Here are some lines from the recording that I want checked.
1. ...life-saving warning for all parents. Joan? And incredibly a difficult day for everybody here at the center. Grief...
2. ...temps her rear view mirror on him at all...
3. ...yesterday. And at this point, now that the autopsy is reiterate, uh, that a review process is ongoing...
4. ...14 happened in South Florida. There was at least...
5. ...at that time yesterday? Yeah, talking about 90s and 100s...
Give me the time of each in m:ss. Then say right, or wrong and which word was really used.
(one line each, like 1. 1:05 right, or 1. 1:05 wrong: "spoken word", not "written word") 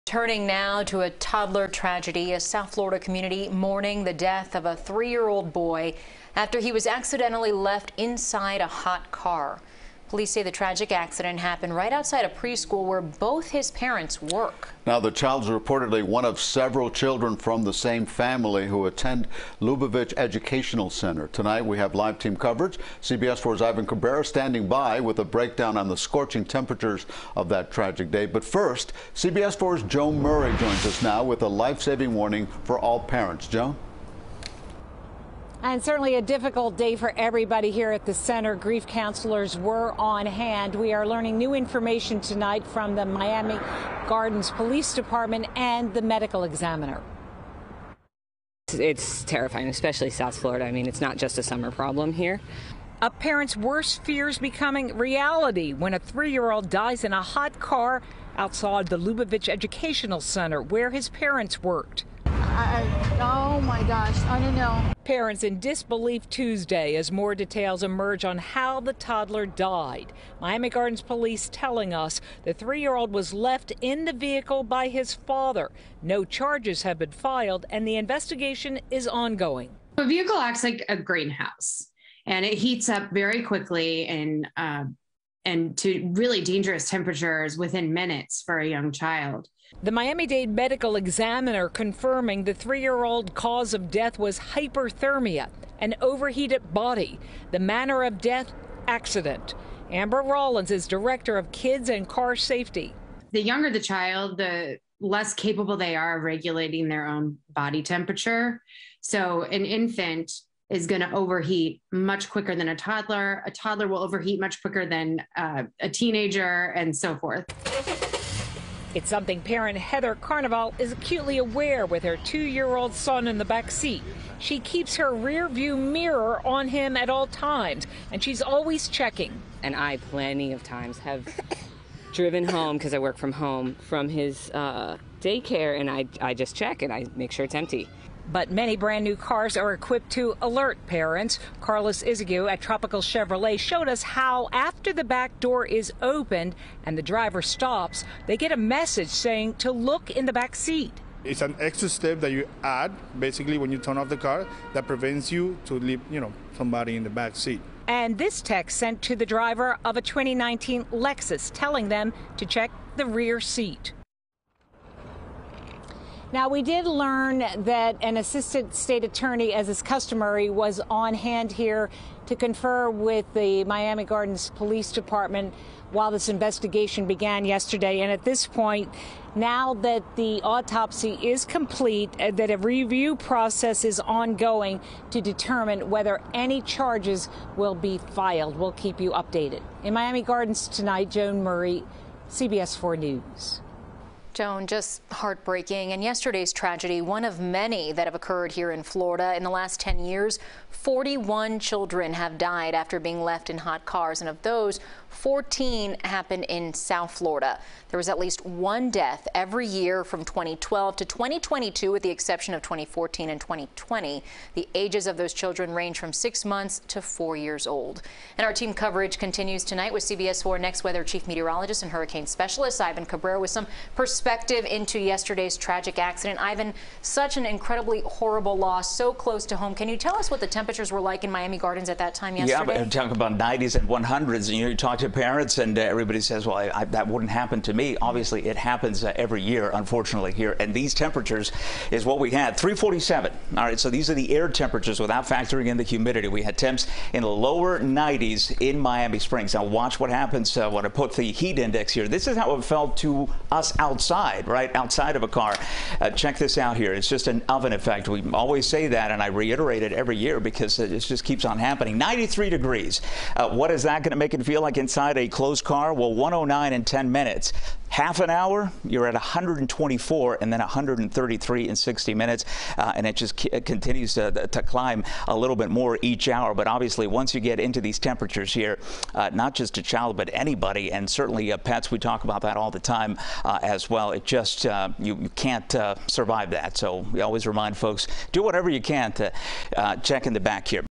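1. 0:31 wrong: "certainly", not "incredibly"
2. 2:04 wrong: "keeps", not "temps"
3. 2:57 wrong: "complete", not "reiterate"
4. 3:25 right
5. 3:51 right.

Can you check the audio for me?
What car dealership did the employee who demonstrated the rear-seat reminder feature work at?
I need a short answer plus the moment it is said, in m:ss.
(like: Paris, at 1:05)
Tropical Chevrolet, at 2:22.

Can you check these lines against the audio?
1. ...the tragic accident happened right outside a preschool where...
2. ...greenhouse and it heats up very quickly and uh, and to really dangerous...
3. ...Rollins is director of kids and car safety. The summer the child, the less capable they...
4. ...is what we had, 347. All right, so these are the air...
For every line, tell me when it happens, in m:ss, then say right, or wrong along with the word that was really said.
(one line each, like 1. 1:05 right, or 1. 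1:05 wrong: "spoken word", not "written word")
1. 0:10 right
2. 1:20 right
3. 1:40 wrong: "younger", not "summer"
4. 4:01 right.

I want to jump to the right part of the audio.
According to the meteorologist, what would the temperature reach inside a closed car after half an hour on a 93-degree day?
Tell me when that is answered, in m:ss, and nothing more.
4:29.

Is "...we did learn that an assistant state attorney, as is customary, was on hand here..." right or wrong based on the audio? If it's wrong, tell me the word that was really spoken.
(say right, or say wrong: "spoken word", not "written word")
right.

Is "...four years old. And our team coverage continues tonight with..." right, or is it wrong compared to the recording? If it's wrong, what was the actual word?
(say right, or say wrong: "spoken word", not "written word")
right.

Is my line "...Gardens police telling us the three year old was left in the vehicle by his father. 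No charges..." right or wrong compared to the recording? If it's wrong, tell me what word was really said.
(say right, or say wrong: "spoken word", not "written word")
right.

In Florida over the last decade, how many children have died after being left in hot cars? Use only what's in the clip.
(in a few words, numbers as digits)
41.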